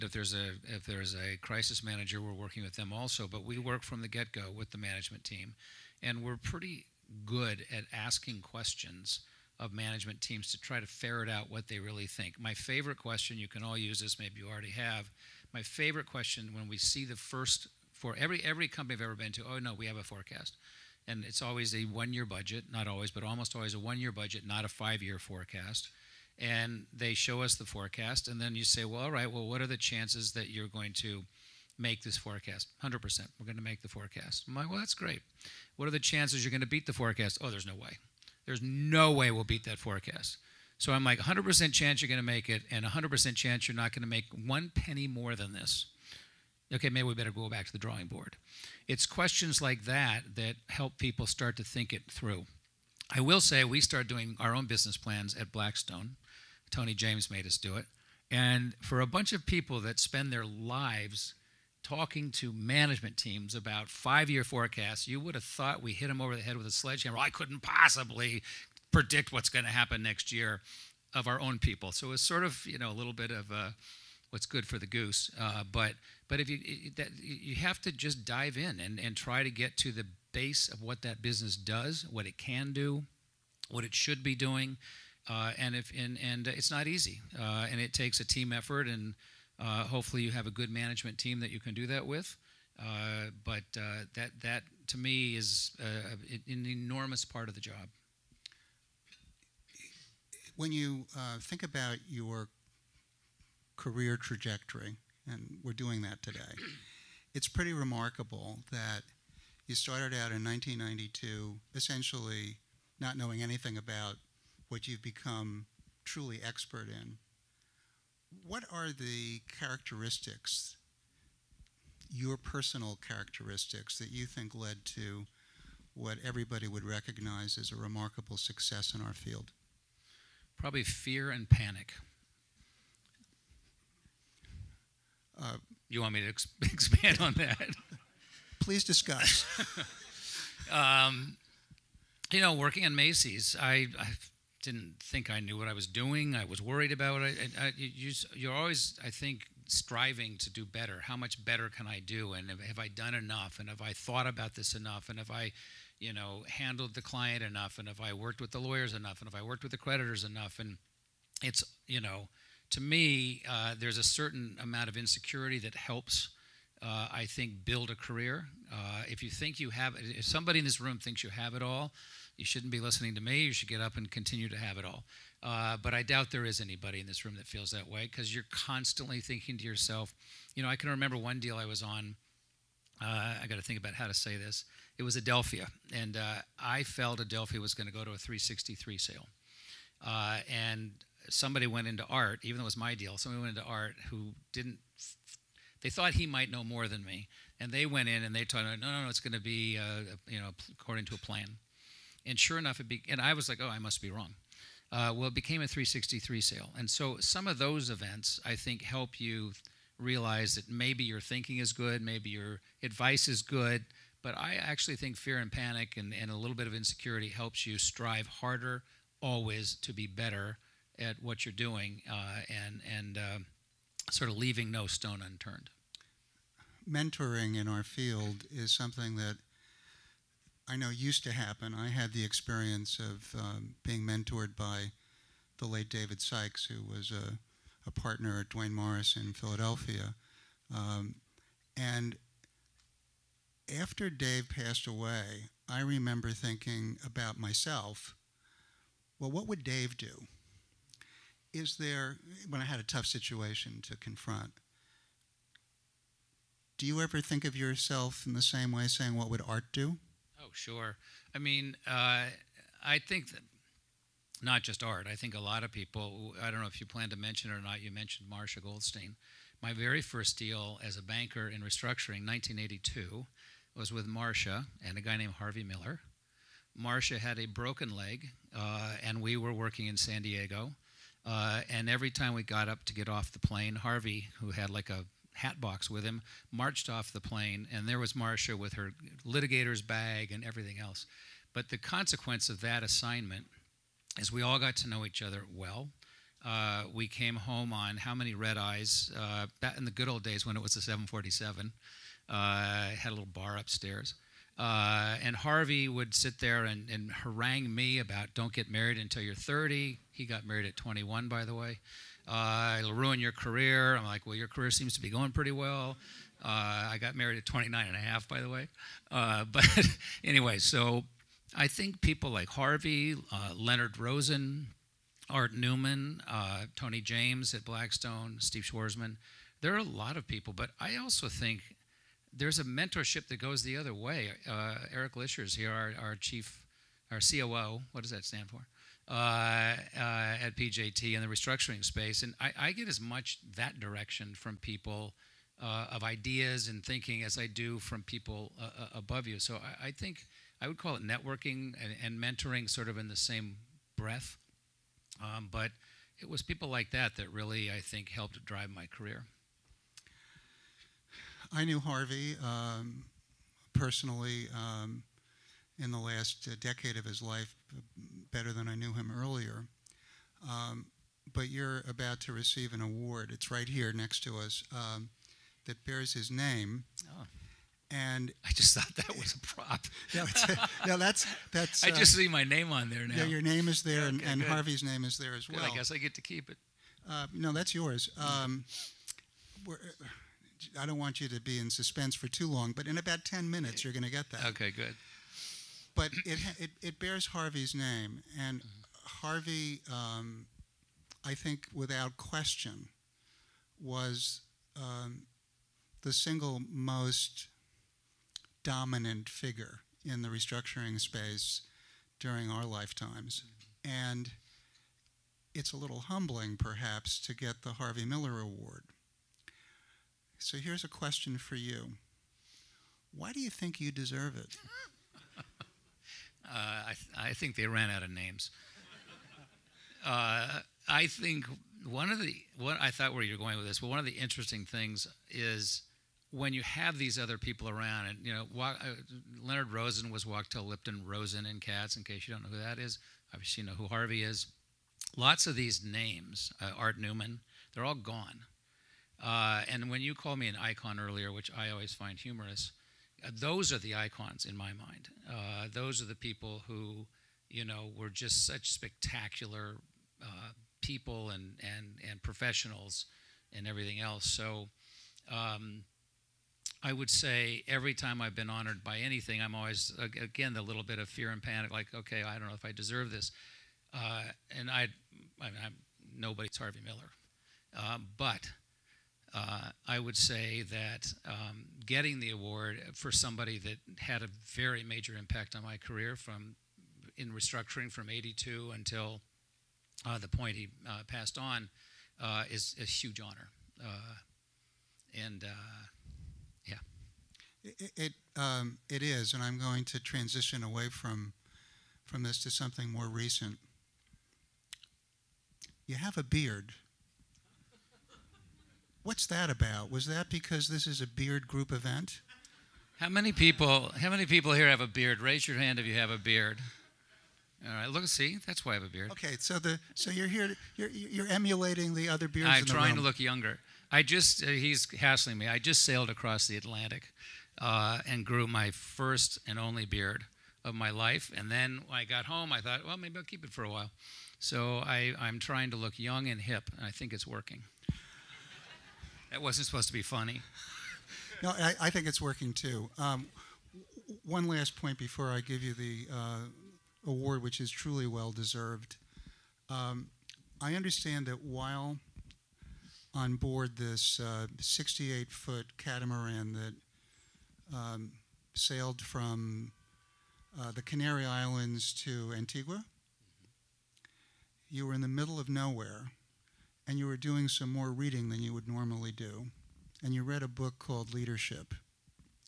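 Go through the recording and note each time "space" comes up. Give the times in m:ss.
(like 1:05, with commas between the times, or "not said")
5:41, 6:50.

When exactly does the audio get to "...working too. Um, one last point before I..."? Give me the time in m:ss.
9:02.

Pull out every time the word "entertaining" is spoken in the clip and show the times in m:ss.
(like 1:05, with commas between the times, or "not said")
not said.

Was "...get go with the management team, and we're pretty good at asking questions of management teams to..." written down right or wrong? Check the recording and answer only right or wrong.
right.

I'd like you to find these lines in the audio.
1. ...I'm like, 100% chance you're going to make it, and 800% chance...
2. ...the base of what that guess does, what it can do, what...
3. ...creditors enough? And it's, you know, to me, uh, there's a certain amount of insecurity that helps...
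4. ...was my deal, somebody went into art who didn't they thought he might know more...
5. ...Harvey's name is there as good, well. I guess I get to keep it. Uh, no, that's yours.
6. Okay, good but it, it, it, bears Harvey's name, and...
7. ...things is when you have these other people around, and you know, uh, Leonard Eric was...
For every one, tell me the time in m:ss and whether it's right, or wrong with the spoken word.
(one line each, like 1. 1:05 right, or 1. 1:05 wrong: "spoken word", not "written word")
1. 0:40 wrong: "100", not "800"
2. 1:19 wrong: "business", not "guess"
3. 2:39 right
4. 3:12 right
5. 6:24 right
6. 6:34 right
7. 7:14 wrong: "Rosen", not "Eric".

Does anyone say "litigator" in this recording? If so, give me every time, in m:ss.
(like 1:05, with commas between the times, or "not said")
4:49.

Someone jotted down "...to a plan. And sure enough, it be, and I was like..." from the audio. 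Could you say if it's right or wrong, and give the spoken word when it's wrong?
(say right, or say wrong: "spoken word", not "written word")
right.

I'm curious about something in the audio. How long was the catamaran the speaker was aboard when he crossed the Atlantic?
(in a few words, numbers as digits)
68 feet.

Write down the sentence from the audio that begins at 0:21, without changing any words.
And it's always a one-year budget, not always, but almost always a one-year budget, not a five-year forecast.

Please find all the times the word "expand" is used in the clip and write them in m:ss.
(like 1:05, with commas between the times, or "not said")
2:16.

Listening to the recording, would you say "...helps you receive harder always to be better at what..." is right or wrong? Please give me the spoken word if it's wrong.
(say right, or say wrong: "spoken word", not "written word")
wrong: "strive", not "receive".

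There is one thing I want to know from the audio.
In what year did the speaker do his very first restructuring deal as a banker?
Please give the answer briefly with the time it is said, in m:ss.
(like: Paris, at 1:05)
1982, at 4:32.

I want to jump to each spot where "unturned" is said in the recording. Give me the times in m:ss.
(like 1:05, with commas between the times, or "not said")
3:45.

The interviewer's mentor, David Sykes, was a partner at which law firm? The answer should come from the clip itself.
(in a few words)
Duane Morris.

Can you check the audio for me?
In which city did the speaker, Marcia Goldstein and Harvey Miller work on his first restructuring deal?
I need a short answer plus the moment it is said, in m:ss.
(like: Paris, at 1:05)
San Diego, at 4:39.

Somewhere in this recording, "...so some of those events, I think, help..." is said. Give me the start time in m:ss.
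3:26.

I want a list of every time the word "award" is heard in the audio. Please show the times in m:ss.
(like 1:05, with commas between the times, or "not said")
6:12, 6:58, 8:02, 9:07.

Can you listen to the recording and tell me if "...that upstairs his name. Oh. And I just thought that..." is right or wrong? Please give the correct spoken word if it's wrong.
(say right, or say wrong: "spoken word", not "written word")
wrong: "bears", not "upstairs".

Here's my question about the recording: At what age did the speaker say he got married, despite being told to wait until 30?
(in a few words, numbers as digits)
29 and a half.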